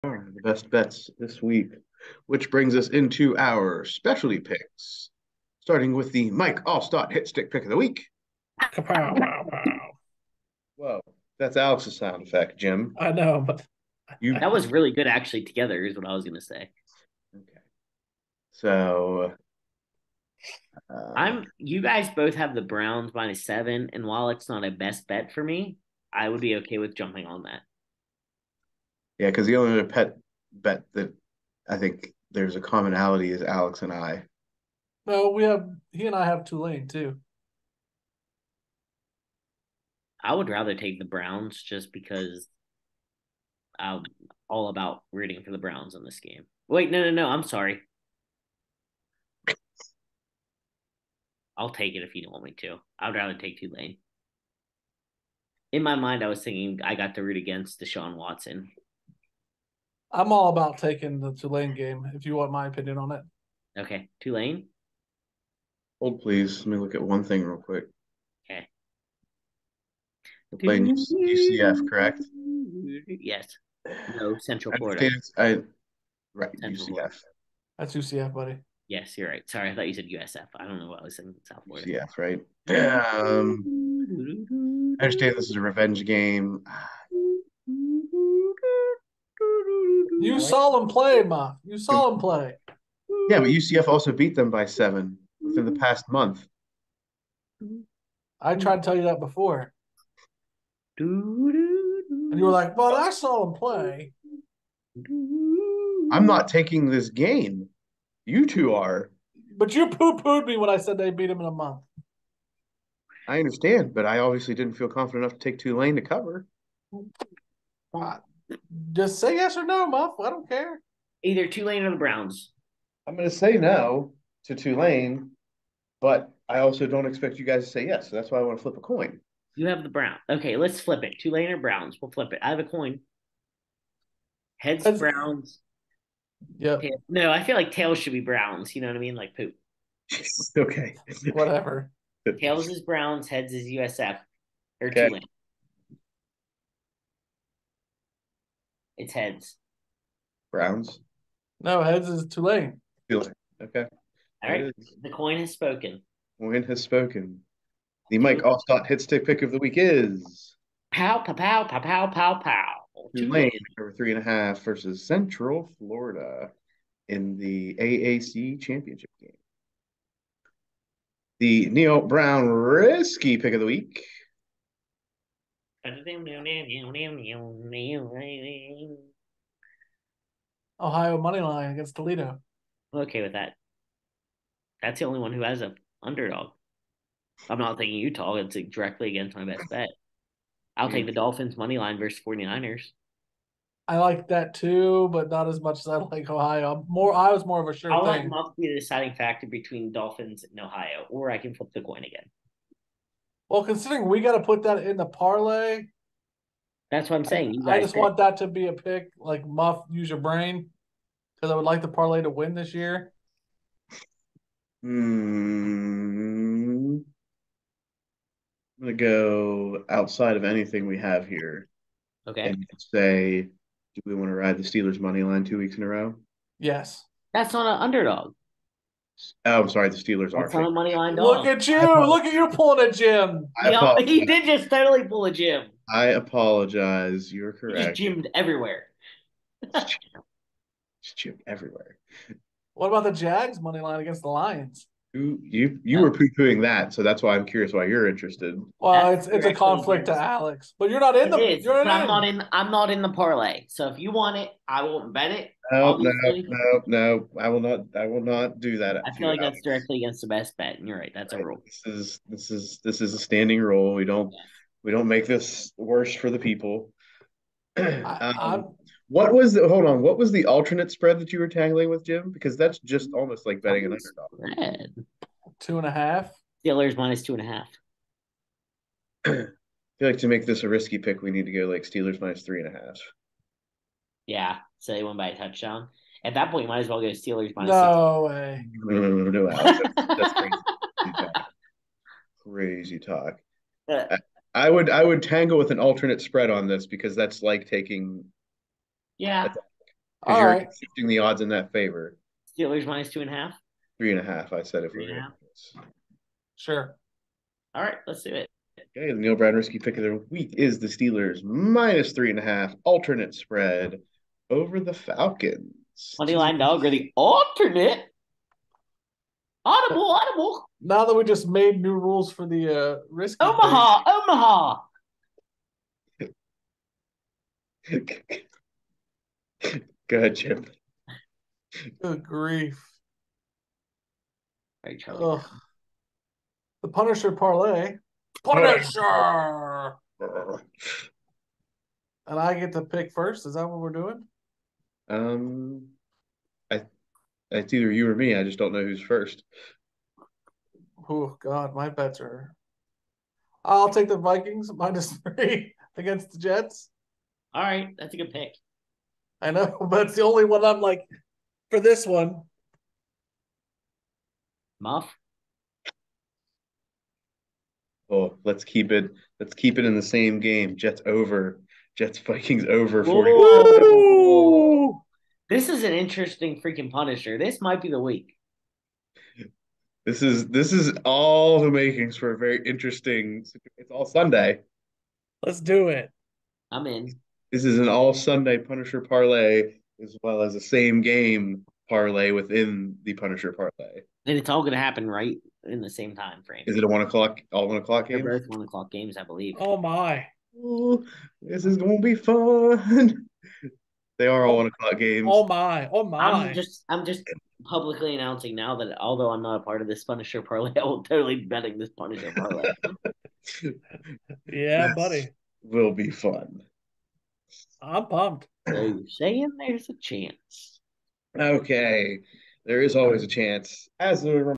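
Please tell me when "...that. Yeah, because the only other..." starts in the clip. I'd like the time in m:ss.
0:27.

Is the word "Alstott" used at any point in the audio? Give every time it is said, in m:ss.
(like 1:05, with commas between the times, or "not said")
0:06, 2:38.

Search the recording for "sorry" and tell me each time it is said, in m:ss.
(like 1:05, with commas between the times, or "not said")
0:47, 1:19, 3:49.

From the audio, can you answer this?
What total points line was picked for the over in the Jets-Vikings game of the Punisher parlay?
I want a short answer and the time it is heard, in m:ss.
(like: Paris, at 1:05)
40, at 6:13.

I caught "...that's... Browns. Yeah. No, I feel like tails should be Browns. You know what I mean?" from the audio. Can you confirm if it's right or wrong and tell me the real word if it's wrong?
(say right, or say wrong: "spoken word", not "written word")
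right.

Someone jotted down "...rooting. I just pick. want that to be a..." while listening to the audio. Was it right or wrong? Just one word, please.
wrong.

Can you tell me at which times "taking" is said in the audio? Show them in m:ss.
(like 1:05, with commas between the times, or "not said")
1:00, 1:46, 4:57.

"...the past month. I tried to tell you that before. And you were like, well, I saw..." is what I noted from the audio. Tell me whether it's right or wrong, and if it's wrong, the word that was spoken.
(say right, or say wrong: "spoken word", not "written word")
right.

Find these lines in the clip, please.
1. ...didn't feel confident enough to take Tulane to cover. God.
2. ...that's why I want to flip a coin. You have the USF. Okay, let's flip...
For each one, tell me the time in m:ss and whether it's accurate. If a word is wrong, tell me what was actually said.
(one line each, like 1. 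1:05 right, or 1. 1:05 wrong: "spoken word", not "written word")
1. 1:54 right
2. 2:08 wrong: "Brown", not "USF".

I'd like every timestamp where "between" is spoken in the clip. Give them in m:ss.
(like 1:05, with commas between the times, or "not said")
3:19.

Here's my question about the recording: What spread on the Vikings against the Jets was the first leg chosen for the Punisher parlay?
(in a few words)
Minus 3.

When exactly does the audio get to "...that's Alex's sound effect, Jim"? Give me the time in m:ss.
0:11.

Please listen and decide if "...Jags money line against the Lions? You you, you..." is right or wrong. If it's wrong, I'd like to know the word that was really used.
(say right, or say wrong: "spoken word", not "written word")
right.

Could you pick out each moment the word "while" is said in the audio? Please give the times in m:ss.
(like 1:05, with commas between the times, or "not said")
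0:24.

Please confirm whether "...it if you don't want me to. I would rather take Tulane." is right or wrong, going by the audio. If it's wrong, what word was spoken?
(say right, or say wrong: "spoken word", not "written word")
right.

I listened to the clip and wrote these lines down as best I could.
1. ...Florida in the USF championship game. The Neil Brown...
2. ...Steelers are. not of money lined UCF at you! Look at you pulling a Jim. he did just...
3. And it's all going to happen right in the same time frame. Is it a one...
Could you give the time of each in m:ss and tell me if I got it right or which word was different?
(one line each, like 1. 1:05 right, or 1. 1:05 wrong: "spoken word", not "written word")
1. 2:45 wrong: "AAC", not "USF"
2. 3:49 wrong: "Look", not "UCF"
3. 6:34 right.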